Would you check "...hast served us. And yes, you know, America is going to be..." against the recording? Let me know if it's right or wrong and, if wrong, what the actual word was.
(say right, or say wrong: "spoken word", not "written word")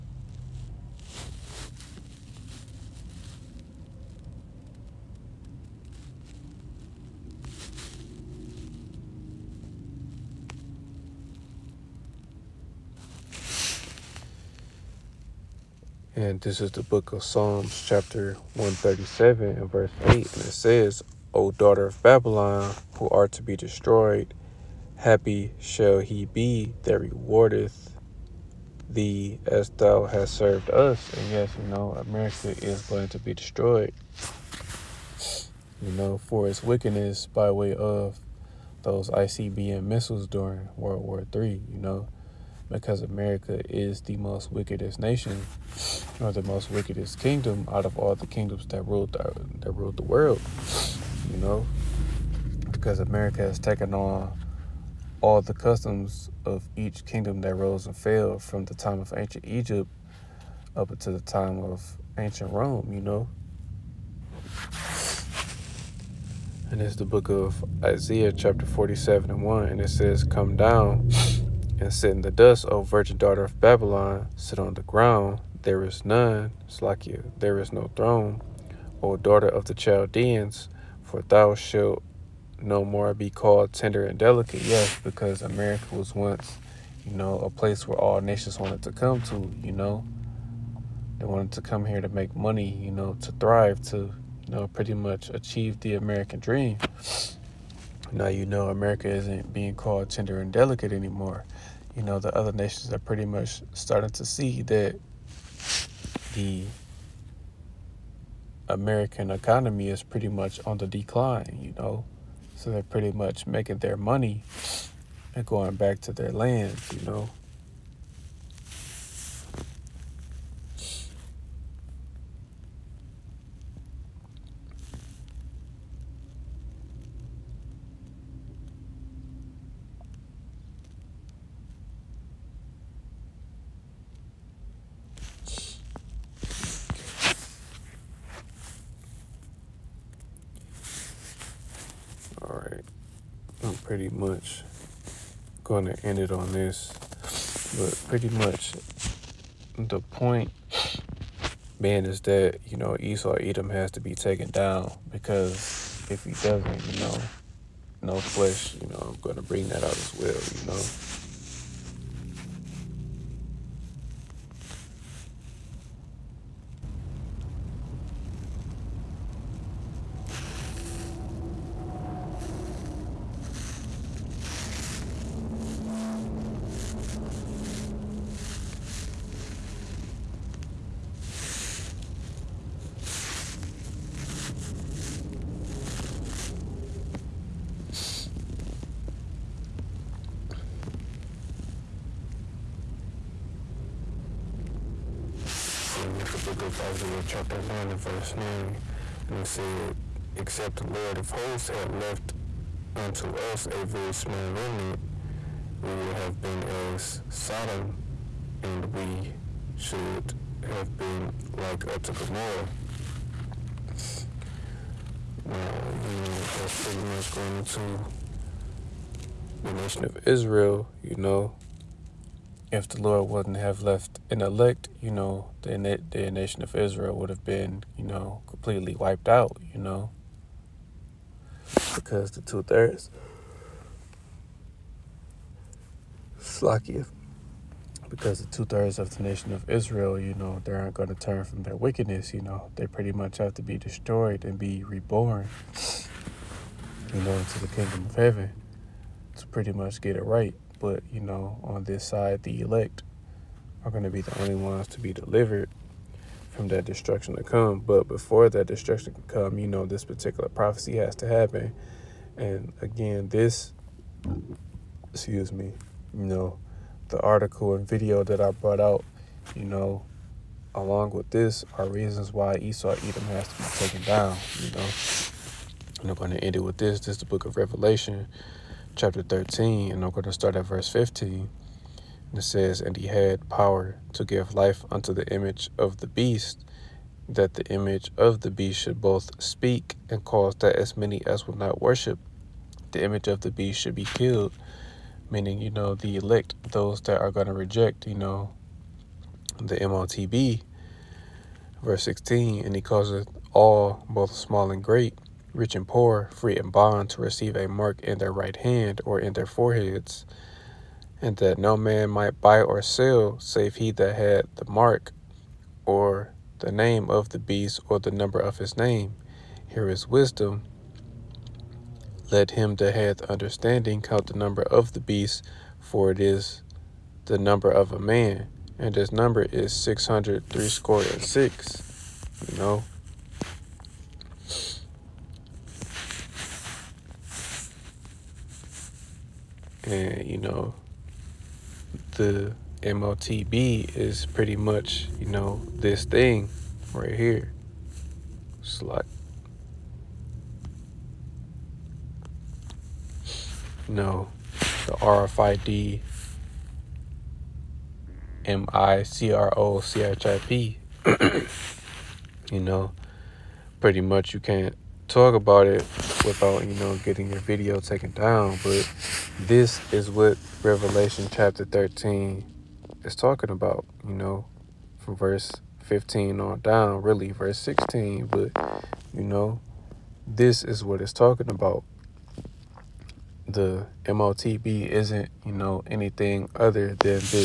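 right.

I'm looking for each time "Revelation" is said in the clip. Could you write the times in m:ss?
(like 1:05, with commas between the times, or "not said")
4:37, 6:10.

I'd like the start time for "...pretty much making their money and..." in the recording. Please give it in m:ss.
1:52.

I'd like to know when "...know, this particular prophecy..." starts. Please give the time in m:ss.
4:19.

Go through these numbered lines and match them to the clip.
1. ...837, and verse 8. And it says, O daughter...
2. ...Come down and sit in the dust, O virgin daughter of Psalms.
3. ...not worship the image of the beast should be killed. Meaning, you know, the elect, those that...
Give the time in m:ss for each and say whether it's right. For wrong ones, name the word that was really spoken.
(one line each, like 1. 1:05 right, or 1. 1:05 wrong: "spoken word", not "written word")
1. 0:18 wrong: "137", not "837"
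2. 1:10 wrong: "Babylon", not "Psalms"
3. 4:51 right.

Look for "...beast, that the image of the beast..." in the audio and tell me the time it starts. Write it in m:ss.
4:46.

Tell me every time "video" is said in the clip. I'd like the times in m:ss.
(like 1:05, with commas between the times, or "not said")
4:27, 6:07.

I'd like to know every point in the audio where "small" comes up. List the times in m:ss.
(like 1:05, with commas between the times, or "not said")
3:24, 5:04.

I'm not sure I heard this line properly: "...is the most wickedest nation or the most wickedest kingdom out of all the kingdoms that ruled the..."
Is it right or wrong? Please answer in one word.
right.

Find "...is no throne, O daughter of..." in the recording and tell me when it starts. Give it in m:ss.
1:17.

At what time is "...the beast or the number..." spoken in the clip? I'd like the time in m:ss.
5:17.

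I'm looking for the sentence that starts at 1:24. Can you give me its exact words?
Yes, because America was once, you know, a place where all nations wanted to come to, you know.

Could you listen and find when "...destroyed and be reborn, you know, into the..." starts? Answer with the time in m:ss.
4:03.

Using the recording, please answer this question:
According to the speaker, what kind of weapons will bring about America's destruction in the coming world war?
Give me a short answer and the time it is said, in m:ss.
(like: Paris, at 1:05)
ICBM missiles, at 0:39.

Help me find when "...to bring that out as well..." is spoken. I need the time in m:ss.
2:39.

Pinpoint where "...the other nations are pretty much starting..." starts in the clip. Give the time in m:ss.
1:42.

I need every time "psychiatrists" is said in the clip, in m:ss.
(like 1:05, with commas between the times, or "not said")
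not said.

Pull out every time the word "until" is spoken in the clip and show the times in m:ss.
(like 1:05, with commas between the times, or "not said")
1:00.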